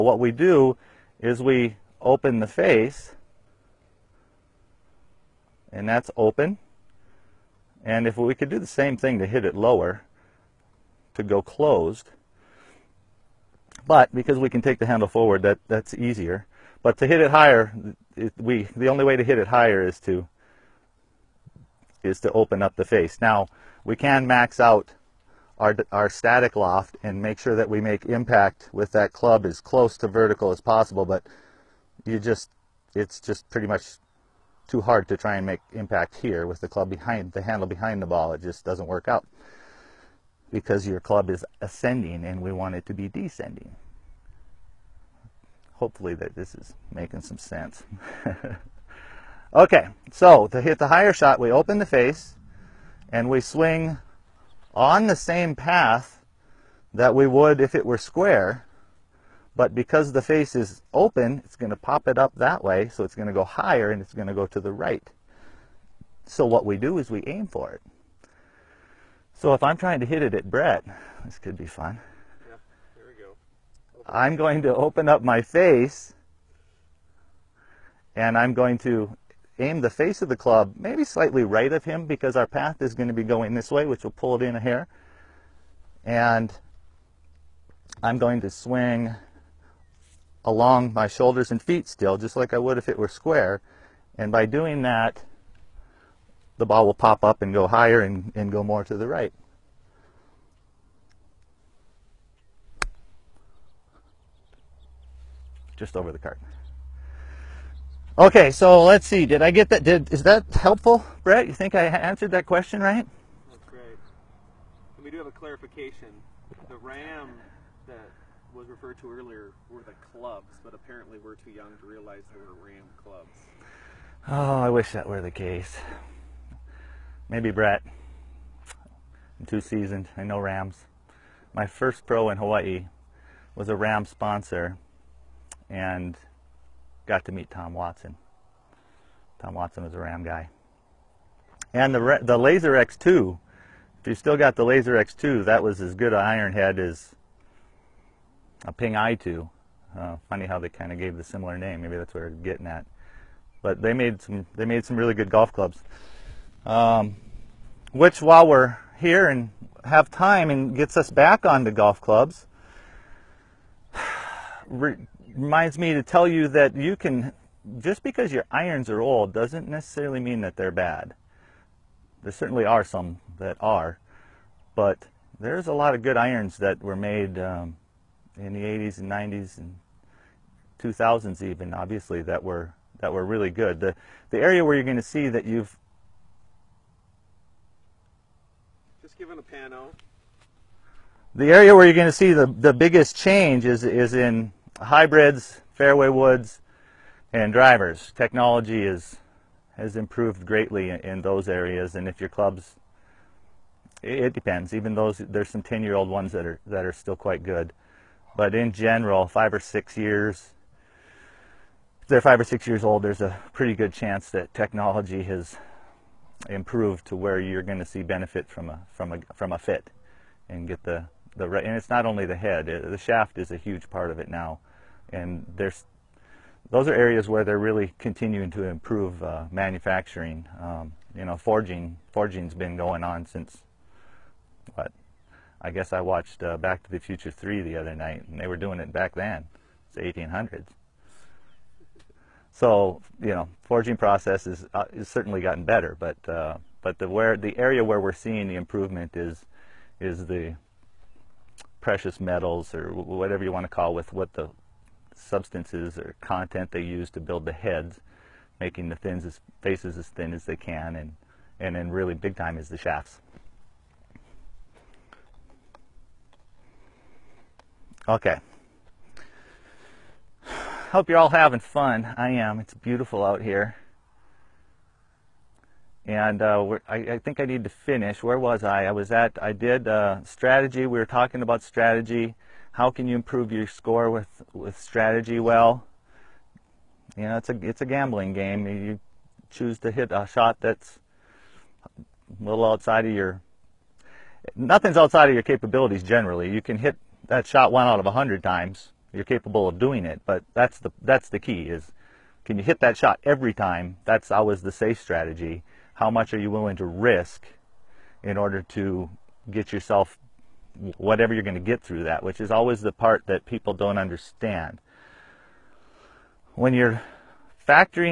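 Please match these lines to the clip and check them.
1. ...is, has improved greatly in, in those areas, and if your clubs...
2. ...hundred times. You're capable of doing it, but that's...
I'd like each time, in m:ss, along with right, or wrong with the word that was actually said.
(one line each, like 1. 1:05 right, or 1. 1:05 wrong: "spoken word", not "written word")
1. 3:18 right
2. 4:58 right.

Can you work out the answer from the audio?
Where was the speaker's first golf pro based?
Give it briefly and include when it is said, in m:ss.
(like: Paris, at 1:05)
Hawaii, at 2:12.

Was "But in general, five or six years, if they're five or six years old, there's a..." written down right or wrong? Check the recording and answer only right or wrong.
right.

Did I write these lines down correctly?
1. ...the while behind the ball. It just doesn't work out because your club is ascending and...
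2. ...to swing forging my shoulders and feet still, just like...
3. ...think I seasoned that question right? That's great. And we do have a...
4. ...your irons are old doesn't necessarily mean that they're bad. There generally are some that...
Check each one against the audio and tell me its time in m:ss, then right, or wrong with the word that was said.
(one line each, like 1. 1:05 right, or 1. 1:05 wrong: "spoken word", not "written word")
1. 0:37 wrong: "handle", not "while"
2. 1:28 wrong: "along", not "forging"
3. 1:51 wrong: "answered", not "seasoned"
4. 2:48 wrong: "certainly", not "generally".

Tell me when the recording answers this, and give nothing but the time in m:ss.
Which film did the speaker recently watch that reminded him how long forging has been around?
3:56.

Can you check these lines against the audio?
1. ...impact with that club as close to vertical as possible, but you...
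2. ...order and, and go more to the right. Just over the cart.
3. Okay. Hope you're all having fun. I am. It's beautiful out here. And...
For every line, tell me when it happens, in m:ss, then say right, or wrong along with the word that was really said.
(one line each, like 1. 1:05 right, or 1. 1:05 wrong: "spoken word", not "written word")
1. 0:28 right
2. 1:37 wrong: "higher", not "order"
3. 4:28 right.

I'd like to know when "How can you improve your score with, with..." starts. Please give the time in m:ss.
4:42.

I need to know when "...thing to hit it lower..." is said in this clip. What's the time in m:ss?
0:08.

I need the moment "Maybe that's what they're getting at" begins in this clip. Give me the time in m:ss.
2:31.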